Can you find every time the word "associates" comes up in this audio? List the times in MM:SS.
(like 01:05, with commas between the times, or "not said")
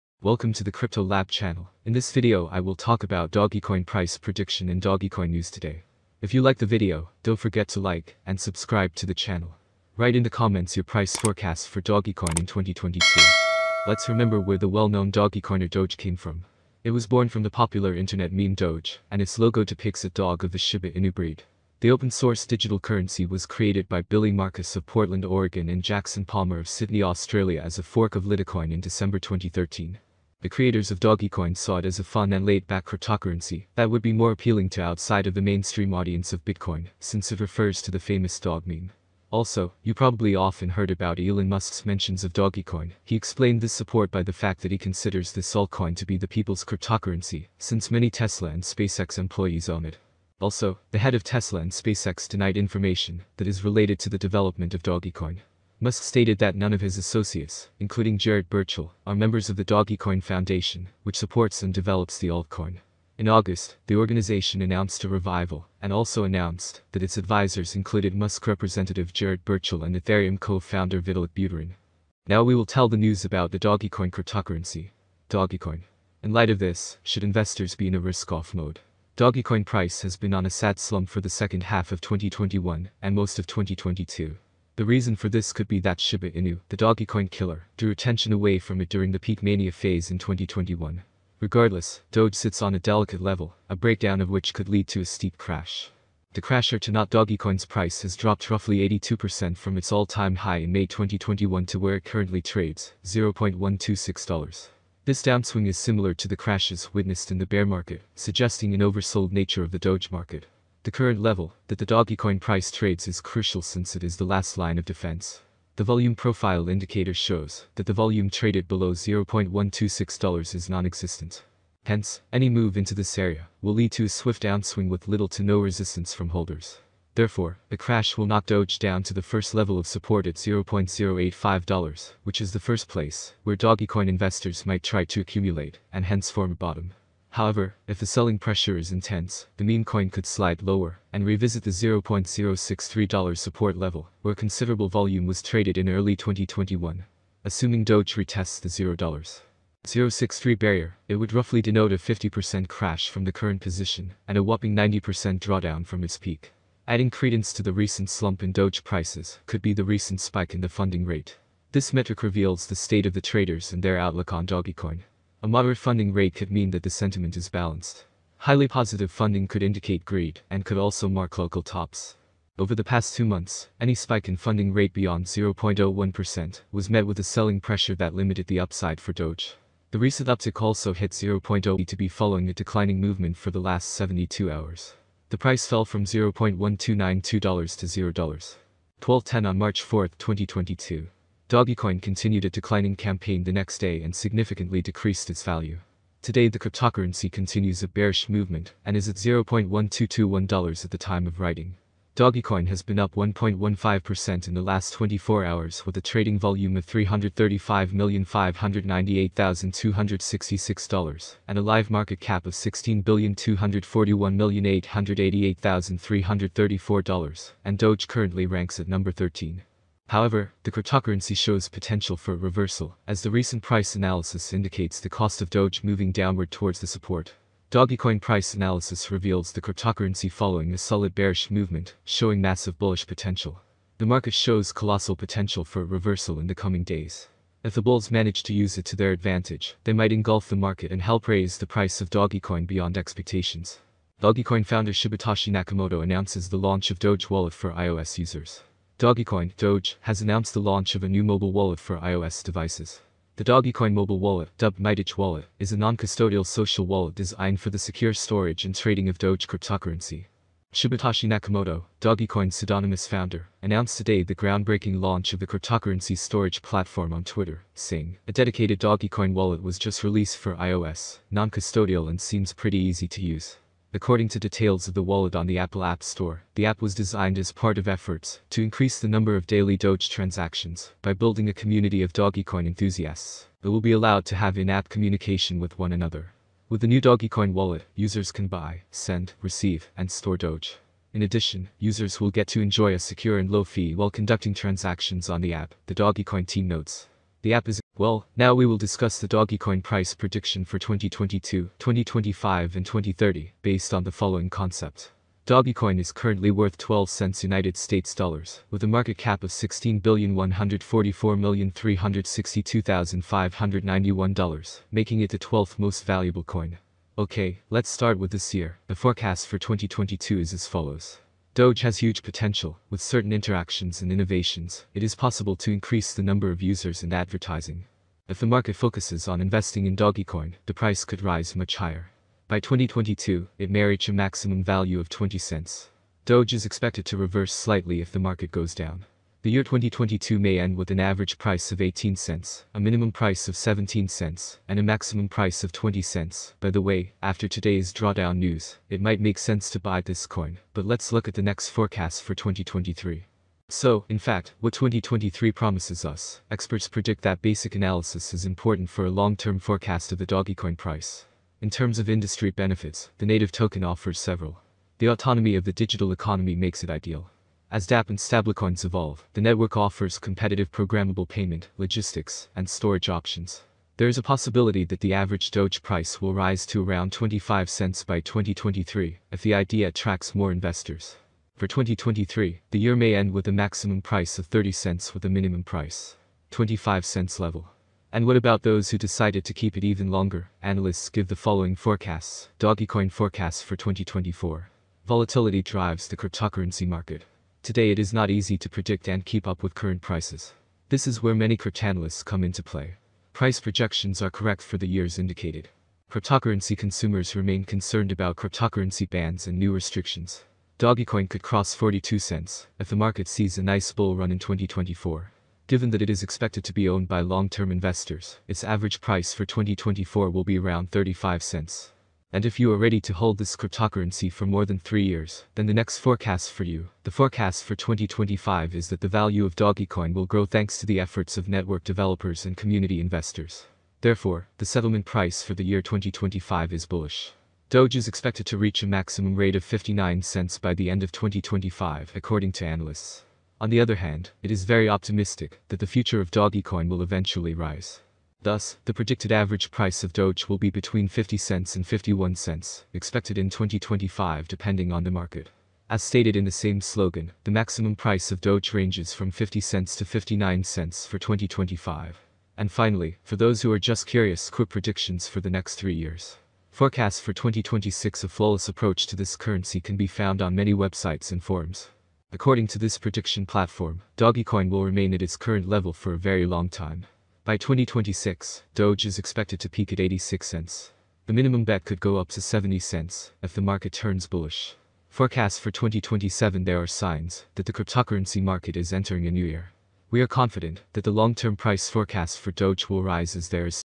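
00:56.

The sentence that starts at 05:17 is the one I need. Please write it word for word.
Okay, let's start with this year.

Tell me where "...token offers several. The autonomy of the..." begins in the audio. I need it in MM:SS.
06:03.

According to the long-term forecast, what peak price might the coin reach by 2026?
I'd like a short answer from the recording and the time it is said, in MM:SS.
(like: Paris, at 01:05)
86 cents, at 07:59.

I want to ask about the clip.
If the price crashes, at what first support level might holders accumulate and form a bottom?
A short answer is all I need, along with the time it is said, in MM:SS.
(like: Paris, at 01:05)
$0.085, at 02:10.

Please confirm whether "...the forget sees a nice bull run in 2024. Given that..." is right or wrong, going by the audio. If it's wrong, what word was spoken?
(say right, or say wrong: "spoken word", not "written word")
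wrong: "market", not "forget".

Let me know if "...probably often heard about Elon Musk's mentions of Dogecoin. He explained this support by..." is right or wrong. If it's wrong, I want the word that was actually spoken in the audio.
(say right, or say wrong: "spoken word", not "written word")
right.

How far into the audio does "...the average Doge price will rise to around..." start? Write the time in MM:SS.
06:14.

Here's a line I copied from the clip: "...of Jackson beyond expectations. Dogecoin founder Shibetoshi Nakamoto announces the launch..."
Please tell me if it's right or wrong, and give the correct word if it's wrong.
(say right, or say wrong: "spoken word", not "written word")
wrong: "Dogecoin", not "Jackson".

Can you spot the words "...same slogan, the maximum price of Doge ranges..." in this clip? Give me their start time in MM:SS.
07:36.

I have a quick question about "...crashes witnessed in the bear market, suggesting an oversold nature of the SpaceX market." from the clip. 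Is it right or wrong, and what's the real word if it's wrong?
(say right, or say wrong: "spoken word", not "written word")
wrong: "Doge", not "SpaceX".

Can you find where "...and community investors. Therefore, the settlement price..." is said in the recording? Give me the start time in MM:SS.
07:12.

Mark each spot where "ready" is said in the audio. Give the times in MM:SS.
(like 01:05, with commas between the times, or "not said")
07:02.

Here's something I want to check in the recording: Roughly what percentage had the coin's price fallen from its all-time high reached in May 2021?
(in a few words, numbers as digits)
82%.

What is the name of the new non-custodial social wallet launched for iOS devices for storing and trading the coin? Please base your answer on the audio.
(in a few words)
MyDoge Wallet.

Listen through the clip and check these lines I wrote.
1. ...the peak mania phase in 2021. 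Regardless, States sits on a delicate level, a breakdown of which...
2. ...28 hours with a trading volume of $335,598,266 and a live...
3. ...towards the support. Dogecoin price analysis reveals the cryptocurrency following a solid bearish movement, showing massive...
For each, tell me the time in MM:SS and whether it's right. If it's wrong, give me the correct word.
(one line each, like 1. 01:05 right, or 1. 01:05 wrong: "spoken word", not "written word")
1. 01:29 wrong: "Doge", not "States"
2. 03:24 wrong: "24", not "28"
3. 03:46 right.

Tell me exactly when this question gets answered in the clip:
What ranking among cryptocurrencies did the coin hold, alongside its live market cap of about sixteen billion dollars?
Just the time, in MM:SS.
03:38.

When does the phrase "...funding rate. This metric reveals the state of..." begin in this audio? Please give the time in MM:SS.
02:40.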